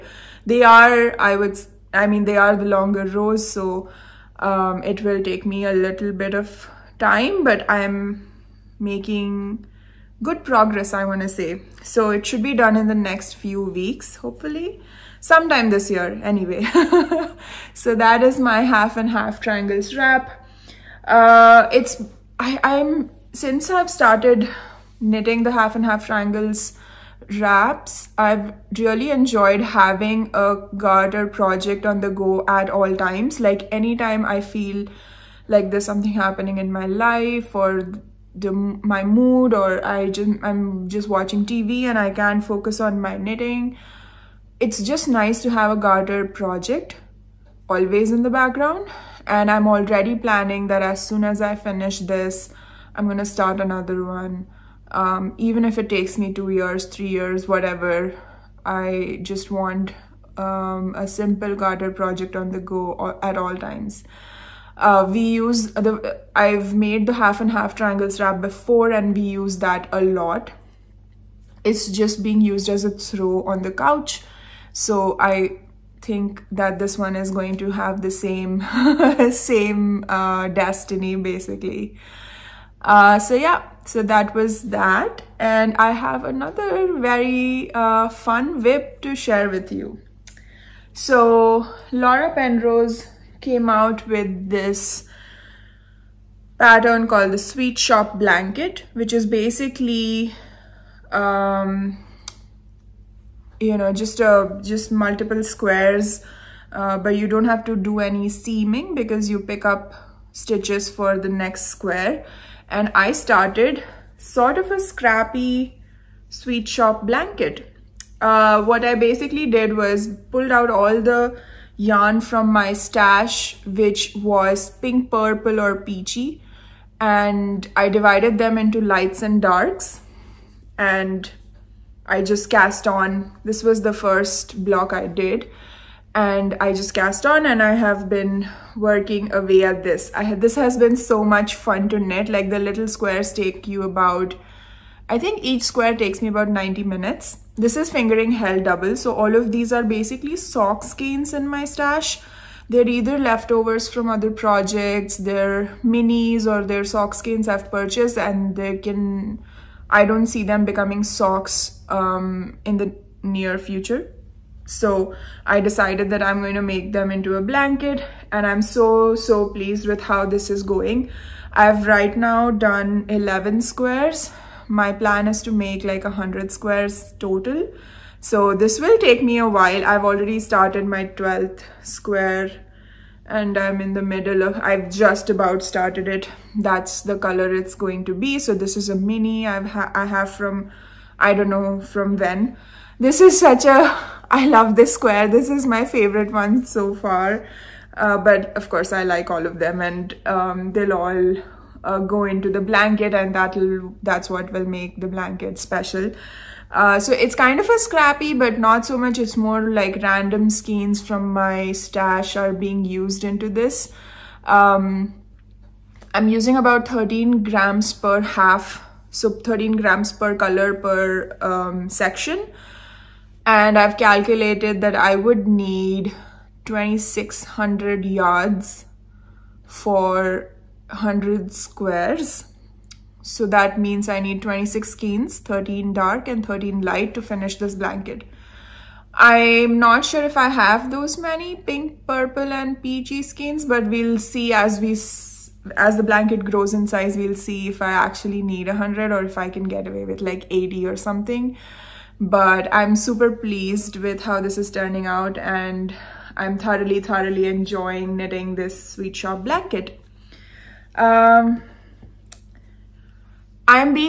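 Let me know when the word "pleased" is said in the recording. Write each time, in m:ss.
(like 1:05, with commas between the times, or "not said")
2:49, 4:13.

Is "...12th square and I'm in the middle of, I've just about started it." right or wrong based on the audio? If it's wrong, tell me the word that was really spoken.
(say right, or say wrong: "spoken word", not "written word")
right.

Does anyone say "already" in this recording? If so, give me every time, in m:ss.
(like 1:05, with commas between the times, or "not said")
0:49, 3:00.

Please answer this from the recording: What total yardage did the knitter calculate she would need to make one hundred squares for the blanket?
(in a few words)
2600 yards.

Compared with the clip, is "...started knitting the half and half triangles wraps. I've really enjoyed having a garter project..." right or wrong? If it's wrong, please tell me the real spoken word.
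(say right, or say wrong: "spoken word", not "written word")
right.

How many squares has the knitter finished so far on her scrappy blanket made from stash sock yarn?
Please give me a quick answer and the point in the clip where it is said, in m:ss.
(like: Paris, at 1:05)
11, at 2:53.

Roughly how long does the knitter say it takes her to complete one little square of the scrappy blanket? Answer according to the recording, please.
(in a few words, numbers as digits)
90 minutes.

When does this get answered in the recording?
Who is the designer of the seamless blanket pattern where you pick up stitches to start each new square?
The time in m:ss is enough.
1:31.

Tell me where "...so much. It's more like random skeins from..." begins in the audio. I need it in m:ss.
3:28.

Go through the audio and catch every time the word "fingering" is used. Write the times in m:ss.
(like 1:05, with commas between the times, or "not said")
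2:27.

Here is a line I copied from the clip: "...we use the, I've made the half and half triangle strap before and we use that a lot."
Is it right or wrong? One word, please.
right.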